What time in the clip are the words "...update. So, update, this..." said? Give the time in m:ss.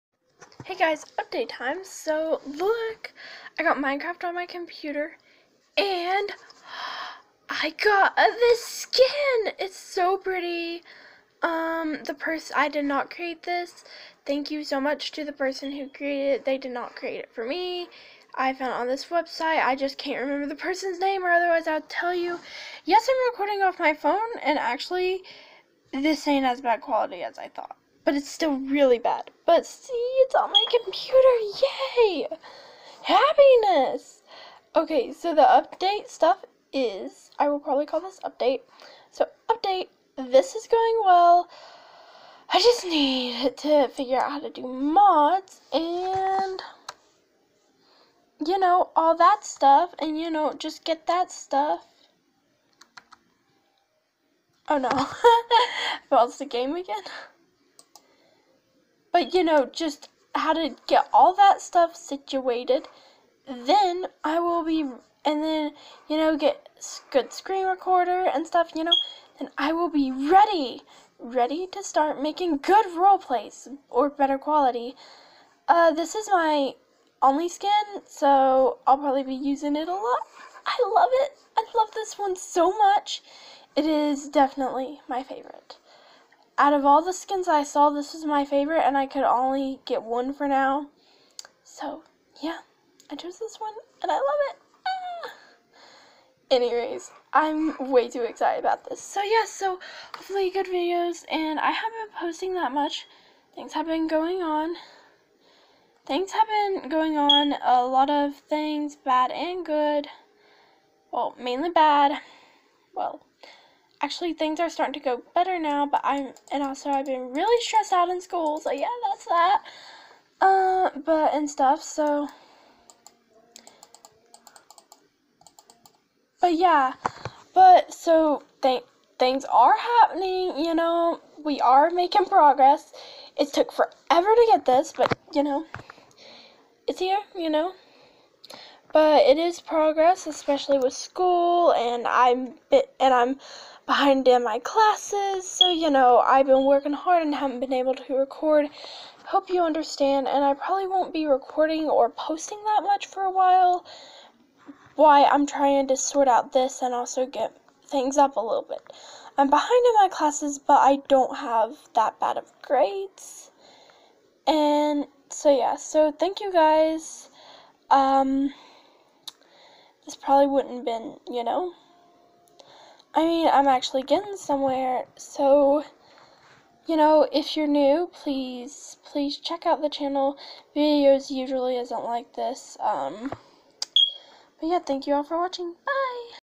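0:38.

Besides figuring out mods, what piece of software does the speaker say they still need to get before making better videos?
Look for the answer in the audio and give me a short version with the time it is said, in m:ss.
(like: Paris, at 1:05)
screen recorder, at 1:07.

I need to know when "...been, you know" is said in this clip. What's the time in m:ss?
2:50.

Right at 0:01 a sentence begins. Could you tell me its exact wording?
So, look, I got Minecraft on my computer and I got this skin.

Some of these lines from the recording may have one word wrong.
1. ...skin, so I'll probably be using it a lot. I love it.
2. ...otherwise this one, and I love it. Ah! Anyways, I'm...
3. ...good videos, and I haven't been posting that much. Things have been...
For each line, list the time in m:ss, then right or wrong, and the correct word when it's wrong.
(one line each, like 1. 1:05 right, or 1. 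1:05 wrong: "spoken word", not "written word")
1. 1:17 right
2. 1:33 wrong: "chose", not "otherwise"
3. 1:40 right.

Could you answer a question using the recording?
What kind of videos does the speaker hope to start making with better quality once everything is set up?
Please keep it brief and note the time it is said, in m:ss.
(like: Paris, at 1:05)
role plays, at 1:12.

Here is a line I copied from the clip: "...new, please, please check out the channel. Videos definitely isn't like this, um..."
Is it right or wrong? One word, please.
wrong.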